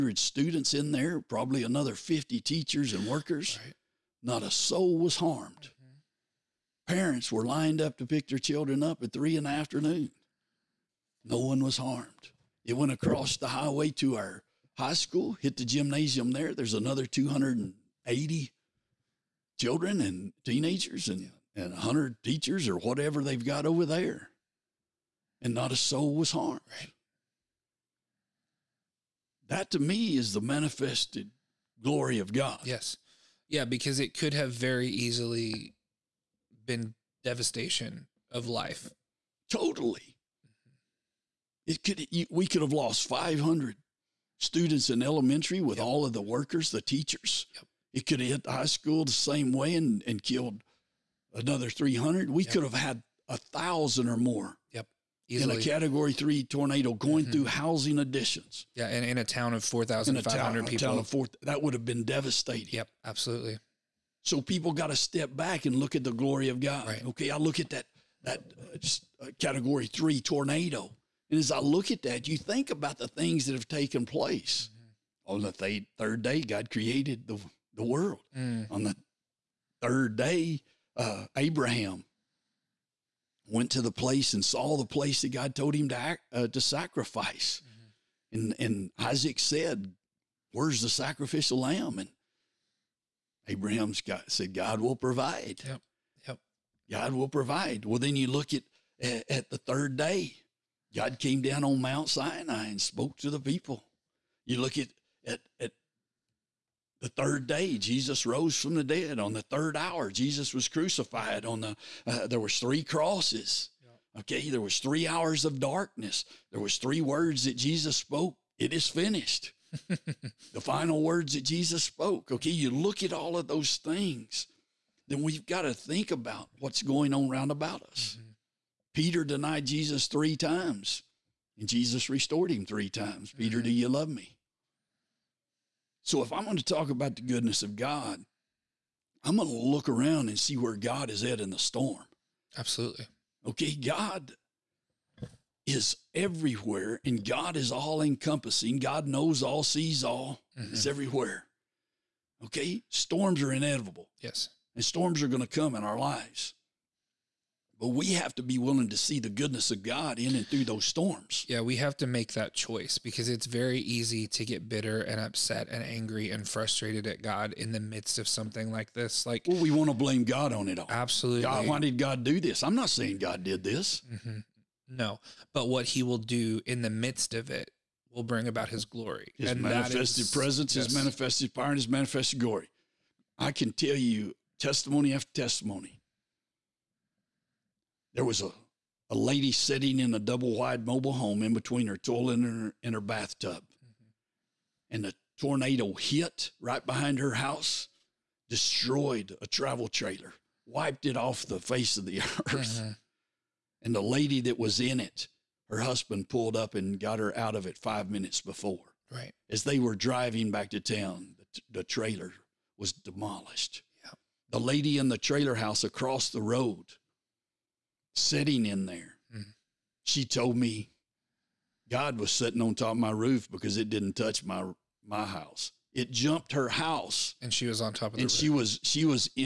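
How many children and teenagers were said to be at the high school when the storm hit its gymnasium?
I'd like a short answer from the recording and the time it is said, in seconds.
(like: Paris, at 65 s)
280, at 16 s.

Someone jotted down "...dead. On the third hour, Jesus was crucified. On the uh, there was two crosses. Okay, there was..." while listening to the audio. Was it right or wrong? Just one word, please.
wrong.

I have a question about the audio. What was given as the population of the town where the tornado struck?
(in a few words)
4,500.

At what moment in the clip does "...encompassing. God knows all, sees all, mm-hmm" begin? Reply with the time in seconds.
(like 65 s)
148 s.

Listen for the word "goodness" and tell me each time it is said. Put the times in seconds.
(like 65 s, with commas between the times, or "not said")
137 s, 159 s.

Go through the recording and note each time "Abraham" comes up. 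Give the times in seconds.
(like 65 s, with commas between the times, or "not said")
81 s, 93 s.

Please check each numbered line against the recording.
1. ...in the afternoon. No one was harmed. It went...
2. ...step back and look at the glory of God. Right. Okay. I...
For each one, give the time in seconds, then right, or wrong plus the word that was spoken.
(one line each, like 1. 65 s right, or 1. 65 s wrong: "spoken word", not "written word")
1. 9 s right
2. 64 s right.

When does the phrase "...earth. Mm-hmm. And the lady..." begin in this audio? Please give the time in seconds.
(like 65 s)
202 s.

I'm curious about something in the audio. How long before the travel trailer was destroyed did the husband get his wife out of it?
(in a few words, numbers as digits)
5 minutes.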